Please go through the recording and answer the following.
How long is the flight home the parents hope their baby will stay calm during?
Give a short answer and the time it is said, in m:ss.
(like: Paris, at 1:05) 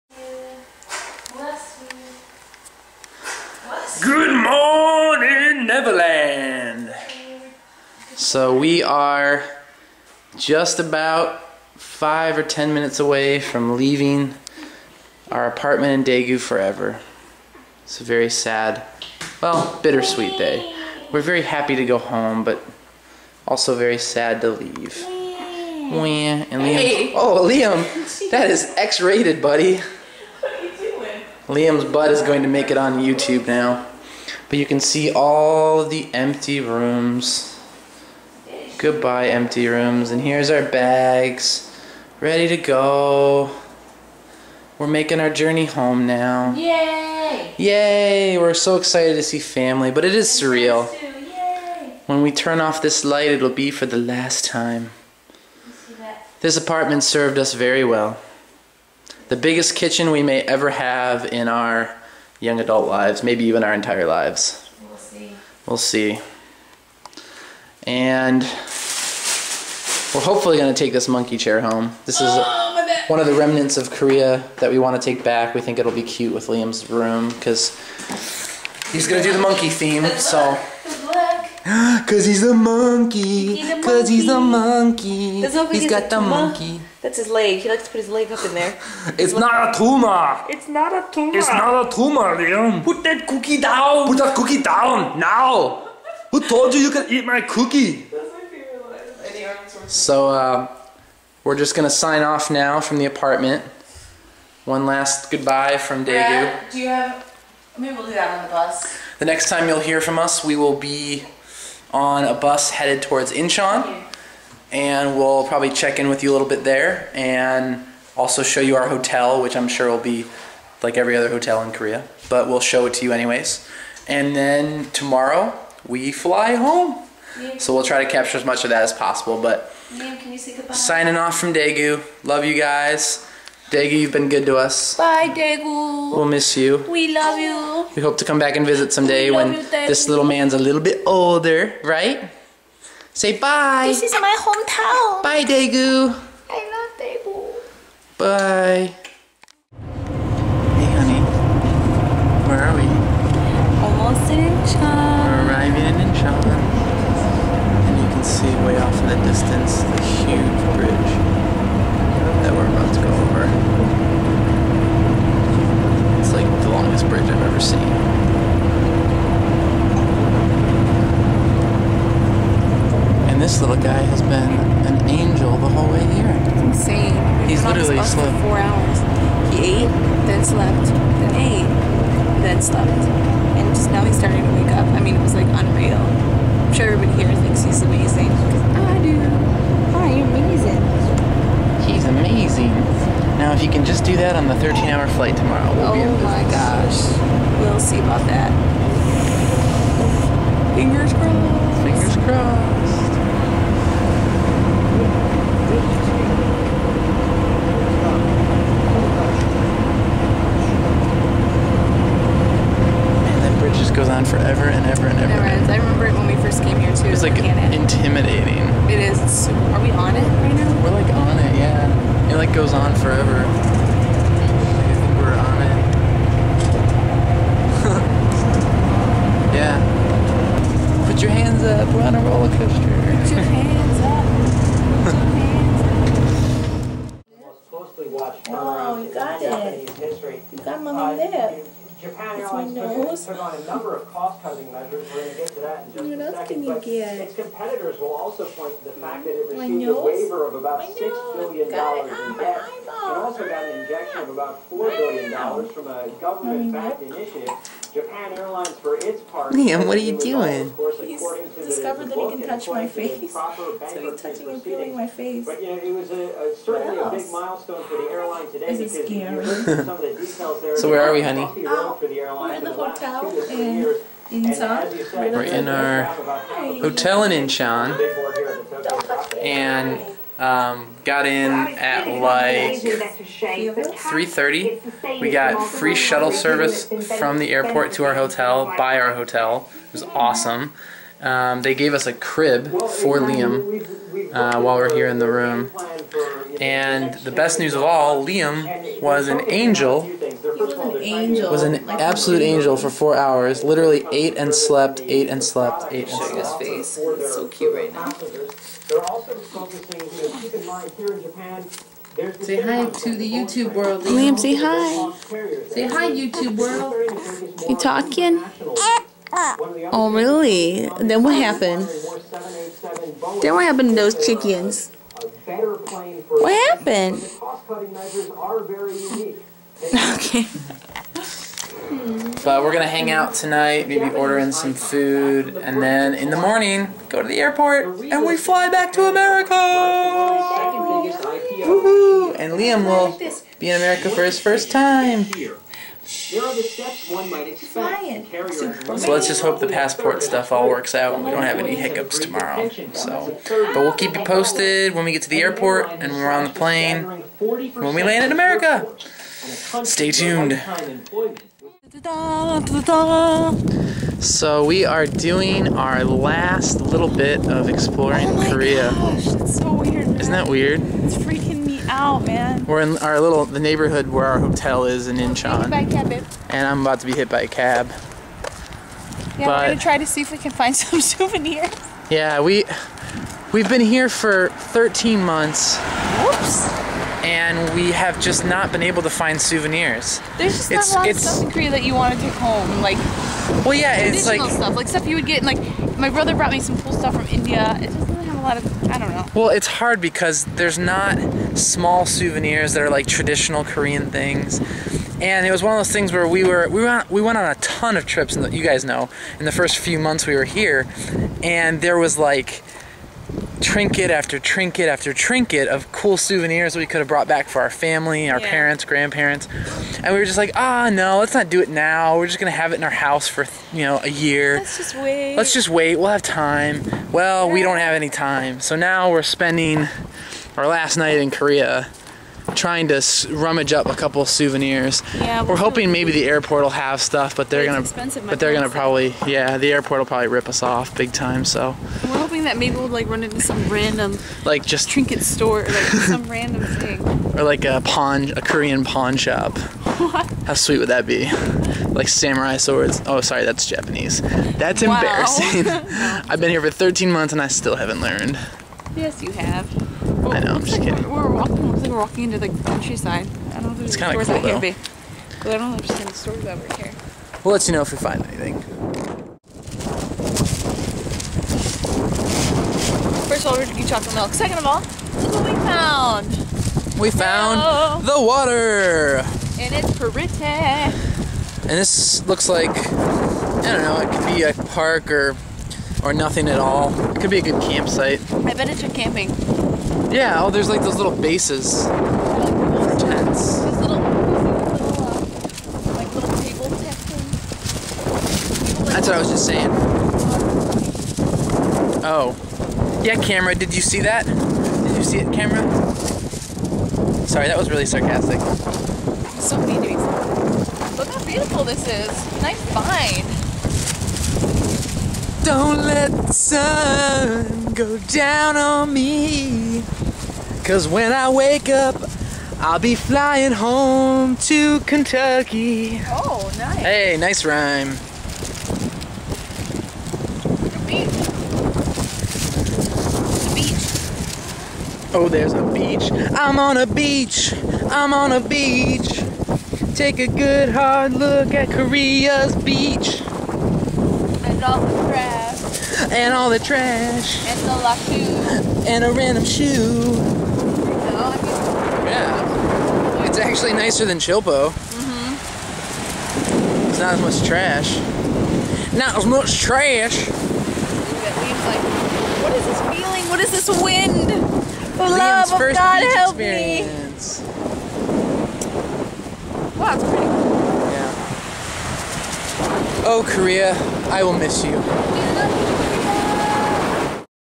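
13 hours, at 3:14.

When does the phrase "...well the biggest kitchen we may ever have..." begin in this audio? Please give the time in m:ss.
0:57.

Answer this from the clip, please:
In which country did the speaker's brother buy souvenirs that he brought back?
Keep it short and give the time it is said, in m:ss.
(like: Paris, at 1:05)
India, at 6:37.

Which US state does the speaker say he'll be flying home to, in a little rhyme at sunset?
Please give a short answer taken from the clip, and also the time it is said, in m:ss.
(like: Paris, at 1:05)
Kentucky, at 8:44.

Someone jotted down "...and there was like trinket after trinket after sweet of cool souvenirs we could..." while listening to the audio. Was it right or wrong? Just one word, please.
wrong.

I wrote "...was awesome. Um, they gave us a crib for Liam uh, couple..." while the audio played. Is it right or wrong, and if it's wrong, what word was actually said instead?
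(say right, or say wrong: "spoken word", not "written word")
wrong: "while", not "couple".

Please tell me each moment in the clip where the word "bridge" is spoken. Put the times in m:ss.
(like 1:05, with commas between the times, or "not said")
2:40, 3:33.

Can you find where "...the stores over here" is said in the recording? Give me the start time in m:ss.
7:46.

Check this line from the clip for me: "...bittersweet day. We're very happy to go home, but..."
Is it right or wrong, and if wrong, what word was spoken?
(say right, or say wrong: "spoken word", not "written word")
right.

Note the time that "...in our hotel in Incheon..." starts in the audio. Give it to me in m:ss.
4:35.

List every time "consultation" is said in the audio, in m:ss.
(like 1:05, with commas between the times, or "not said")
not said.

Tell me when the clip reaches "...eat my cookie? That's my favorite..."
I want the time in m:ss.
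1:37.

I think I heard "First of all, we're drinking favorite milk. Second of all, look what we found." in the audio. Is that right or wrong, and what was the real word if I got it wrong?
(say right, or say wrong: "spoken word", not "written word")
wrong: "chocolate", not "favorite".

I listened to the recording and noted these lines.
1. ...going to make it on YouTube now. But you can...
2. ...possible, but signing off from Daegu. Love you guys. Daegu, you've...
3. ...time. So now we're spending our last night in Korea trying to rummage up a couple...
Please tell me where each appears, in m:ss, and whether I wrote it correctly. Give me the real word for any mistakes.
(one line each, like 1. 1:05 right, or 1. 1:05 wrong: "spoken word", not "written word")
1. 0:32 right
2. 2:08 right
3. 7:08 right.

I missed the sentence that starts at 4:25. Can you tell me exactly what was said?
But, you know, it was a, a, certainly a big milestone for the airline today.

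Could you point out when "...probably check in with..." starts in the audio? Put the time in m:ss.
1:55.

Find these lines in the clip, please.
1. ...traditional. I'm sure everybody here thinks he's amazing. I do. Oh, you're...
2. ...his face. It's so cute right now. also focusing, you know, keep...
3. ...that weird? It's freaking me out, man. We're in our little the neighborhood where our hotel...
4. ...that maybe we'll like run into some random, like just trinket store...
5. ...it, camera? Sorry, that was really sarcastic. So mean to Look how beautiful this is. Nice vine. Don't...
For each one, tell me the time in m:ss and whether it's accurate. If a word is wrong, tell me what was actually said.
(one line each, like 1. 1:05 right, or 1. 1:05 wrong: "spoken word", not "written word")
1. 3:05 wrong: "unreal", not "traditional"
2. 5:06 right
3. 6:10 right
4. 7:22 right
5. 8:25 right.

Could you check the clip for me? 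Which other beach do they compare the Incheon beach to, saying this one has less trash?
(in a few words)
Chilpo.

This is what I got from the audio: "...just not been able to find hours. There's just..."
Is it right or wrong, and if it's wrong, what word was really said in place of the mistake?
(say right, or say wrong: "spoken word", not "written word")
wrong: "souvenirs", not "hours".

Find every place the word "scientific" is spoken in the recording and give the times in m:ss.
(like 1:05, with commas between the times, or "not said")
not said.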